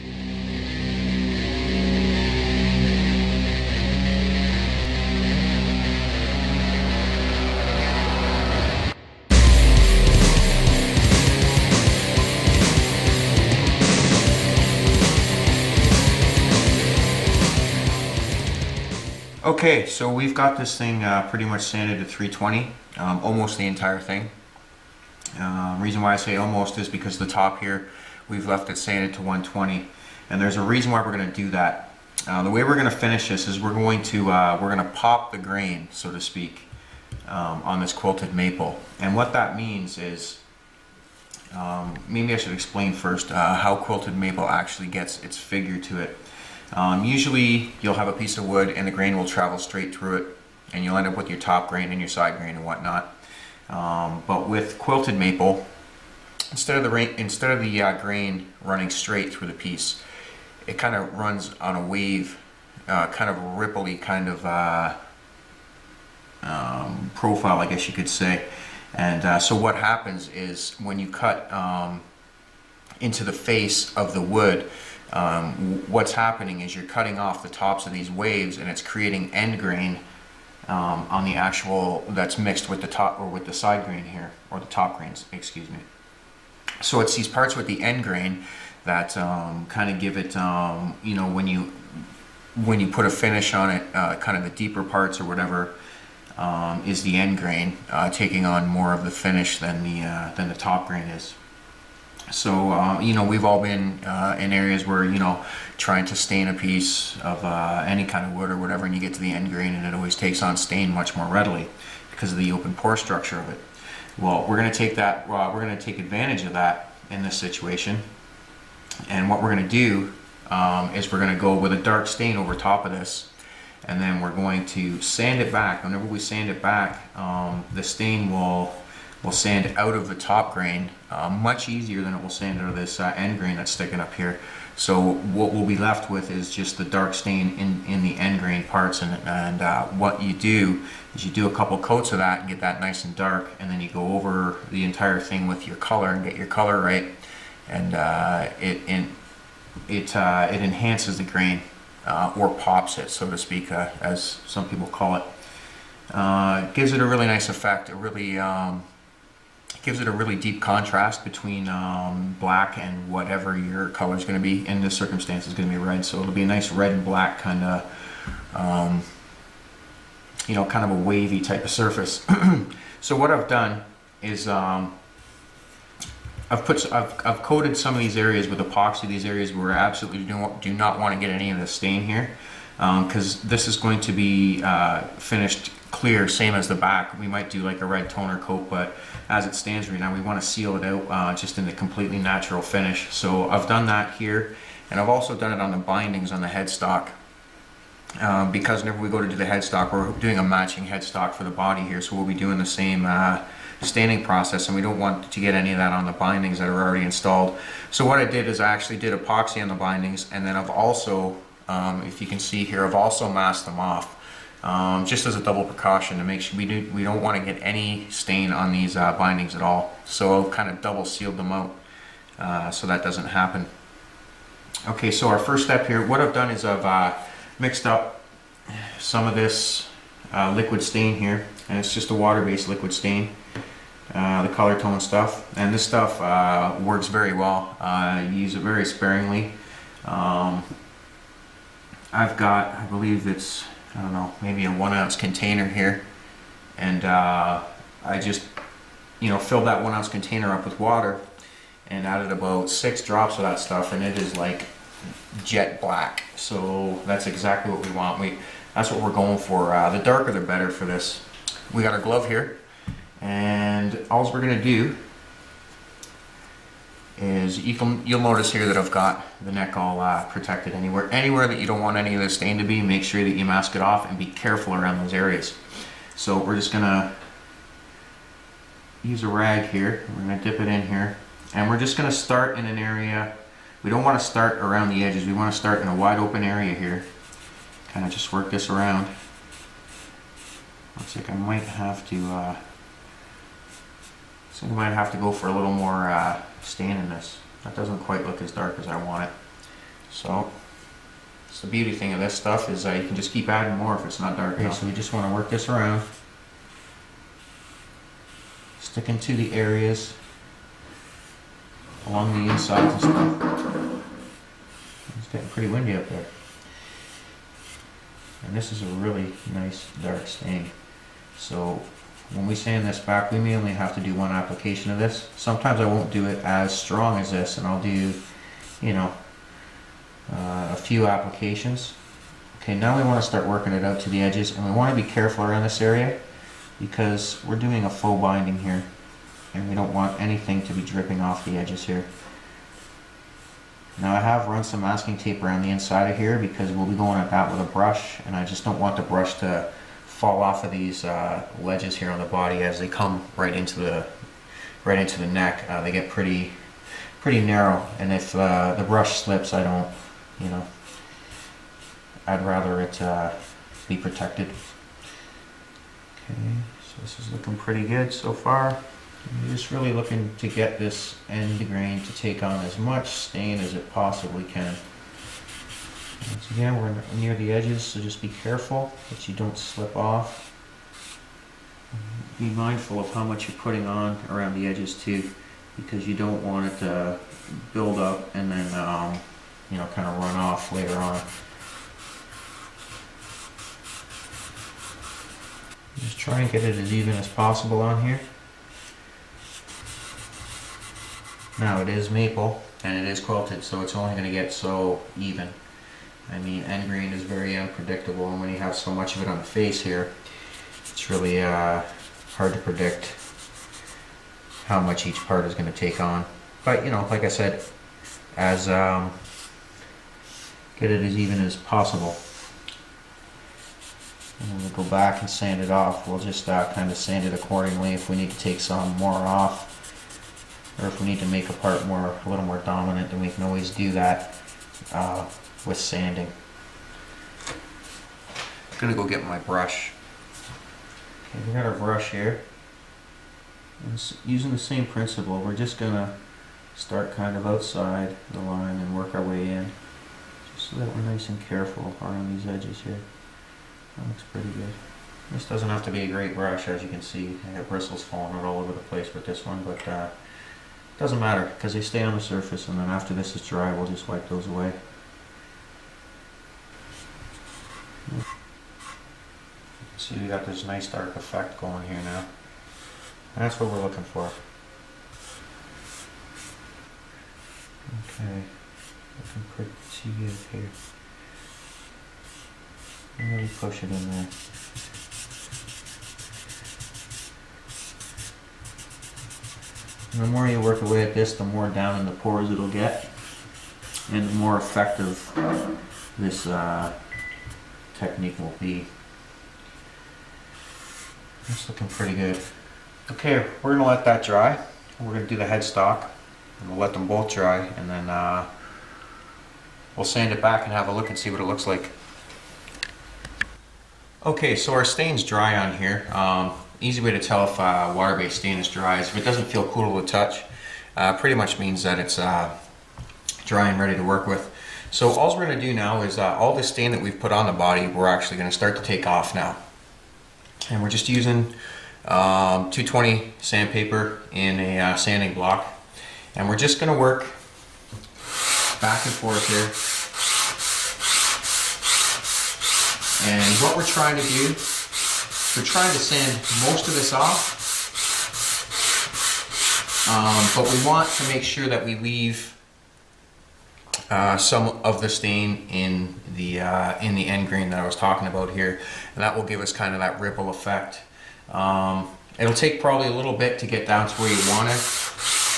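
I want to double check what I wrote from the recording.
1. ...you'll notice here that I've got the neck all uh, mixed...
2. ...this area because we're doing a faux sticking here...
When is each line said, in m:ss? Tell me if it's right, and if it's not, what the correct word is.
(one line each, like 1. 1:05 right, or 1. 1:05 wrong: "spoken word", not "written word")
1. 4:28 wrong: "protected", not "mixed"
2. 5:35 wrong: "binding", not "sticking".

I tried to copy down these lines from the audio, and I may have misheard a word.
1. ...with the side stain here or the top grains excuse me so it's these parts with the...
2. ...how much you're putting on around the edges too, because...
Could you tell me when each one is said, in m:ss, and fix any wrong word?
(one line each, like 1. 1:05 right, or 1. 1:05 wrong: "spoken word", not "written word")
1. 1:23 wrong: "grain", not "stain"
2. 6:23 right.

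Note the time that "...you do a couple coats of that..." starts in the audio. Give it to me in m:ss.
2:21.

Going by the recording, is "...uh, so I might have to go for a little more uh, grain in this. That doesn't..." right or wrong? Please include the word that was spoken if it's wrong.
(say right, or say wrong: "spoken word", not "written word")
wrong: "stain", not "grain".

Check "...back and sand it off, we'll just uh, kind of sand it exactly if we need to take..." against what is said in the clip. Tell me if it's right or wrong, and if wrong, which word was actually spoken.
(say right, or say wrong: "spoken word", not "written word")
wrong: "accordingly", not "exactly".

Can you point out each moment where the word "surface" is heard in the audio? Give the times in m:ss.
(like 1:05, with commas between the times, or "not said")
2:51, 7:42.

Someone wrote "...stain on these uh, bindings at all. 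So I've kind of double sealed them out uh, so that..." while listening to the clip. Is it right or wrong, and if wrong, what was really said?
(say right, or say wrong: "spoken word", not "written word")
right.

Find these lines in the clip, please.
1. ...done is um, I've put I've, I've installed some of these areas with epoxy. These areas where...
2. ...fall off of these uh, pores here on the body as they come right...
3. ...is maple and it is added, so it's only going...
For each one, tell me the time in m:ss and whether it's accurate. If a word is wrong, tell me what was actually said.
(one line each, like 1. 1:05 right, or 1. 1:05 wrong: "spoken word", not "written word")
1. 2:53 wrong: "coated", not "installed"
2. 5:50 wrong: "ledges", not "pores"
3. 6:41 wrong: "quilted", not "added".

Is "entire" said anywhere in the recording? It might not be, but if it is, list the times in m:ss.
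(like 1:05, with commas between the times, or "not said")
0:23, 2:24.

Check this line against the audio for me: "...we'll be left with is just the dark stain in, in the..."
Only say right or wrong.
right.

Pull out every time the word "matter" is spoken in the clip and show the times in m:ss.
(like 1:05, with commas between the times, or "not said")
7:41.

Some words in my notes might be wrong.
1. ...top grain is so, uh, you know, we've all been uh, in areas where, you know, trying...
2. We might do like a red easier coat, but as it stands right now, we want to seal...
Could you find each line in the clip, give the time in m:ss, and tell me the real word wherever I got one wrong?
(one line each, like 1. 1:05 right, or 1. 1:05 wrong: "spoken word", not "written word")
1. 1:40 right
2. 3:07 wrong: "toner", not "easier".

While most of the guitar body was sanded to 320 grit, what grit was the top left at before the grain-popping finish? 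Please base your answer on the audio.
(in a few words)
120.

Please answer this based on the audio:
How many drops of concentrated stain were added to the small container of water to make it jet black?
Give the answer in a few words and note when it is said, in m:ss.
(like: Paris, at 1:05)
6, at 4:12.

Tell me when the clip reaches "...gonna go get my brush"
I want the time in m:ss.
7:18.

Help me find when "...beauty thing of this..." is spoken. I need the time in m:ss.
5:01.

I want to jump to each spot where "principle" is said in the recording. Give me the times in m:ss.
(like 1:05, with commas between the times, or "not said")
7:24.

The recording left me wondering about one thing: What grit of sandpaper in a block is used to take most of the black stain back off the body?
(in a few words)
220.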